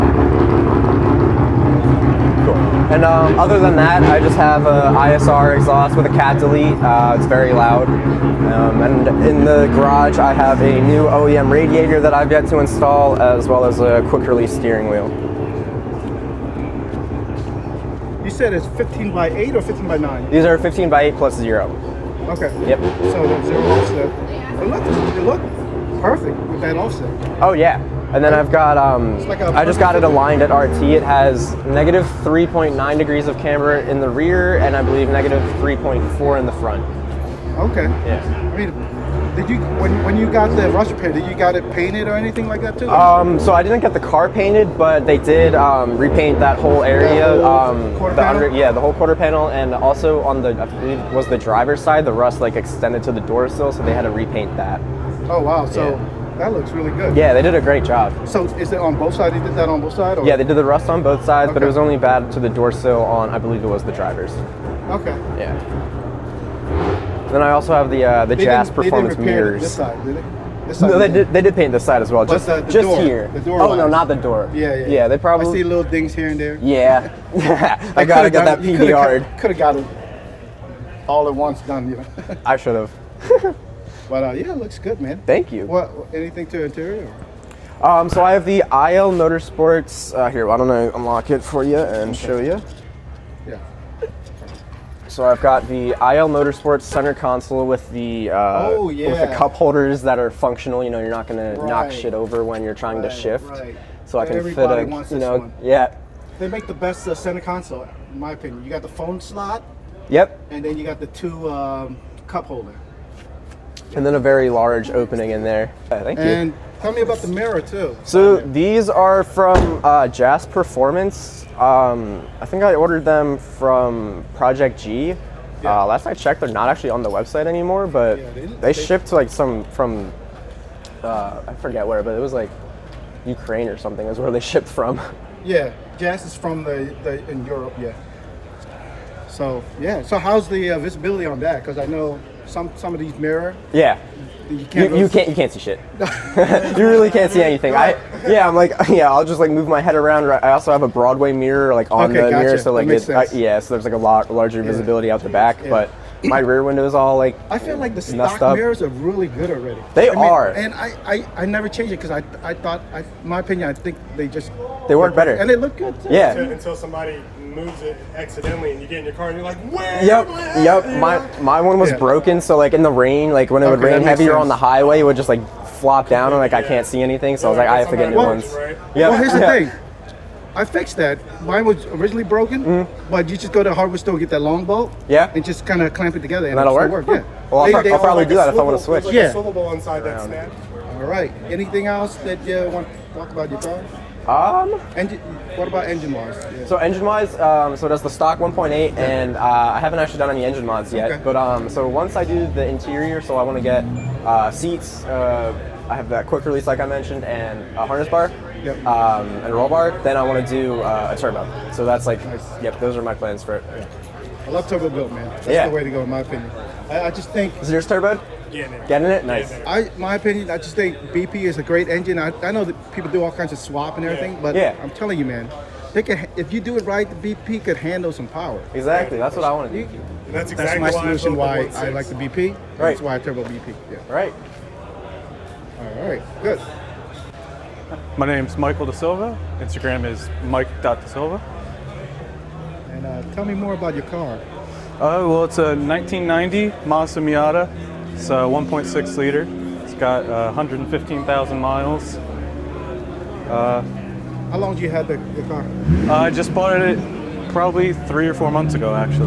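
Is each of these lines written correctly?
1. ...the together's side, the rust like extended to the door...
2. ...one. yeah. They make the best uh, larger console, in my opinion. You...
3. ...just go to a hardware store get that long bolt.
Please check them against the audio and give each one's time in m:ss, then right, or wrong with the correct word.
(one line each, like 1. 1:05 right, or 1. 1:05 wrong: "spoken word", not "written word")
1. 0:51 wrong: "driver", not "together"
2. 1:45 wrong: "center", not "larger"
3. 3:03 right.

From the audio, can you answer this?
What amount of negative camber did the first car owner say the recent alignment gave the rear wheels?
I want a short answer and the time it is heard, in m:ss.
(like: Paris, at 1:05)
-3.9 degrees, at 0:31.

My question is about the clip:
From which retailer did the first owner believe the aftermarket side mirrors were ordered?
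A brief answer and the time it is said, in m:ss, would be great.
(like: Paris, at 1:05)
Project G, at 2:04.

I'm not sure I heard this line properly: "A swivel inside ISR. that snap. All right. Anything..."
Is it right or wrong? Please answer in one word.
wrong.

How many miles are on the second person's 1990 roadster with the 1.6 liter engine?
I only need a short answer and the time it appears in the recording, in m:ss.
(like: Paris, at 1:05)
115,000, at 4:10.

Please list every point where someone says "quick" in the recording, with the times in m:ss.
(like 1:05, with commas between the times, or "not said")
0:14, 3:26.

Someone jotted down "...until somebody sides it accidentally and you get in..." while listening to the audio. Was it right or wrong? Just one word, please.
wrong.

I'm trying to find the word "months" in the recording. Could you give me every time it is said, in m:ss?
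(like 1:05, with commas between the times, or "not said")
4:18.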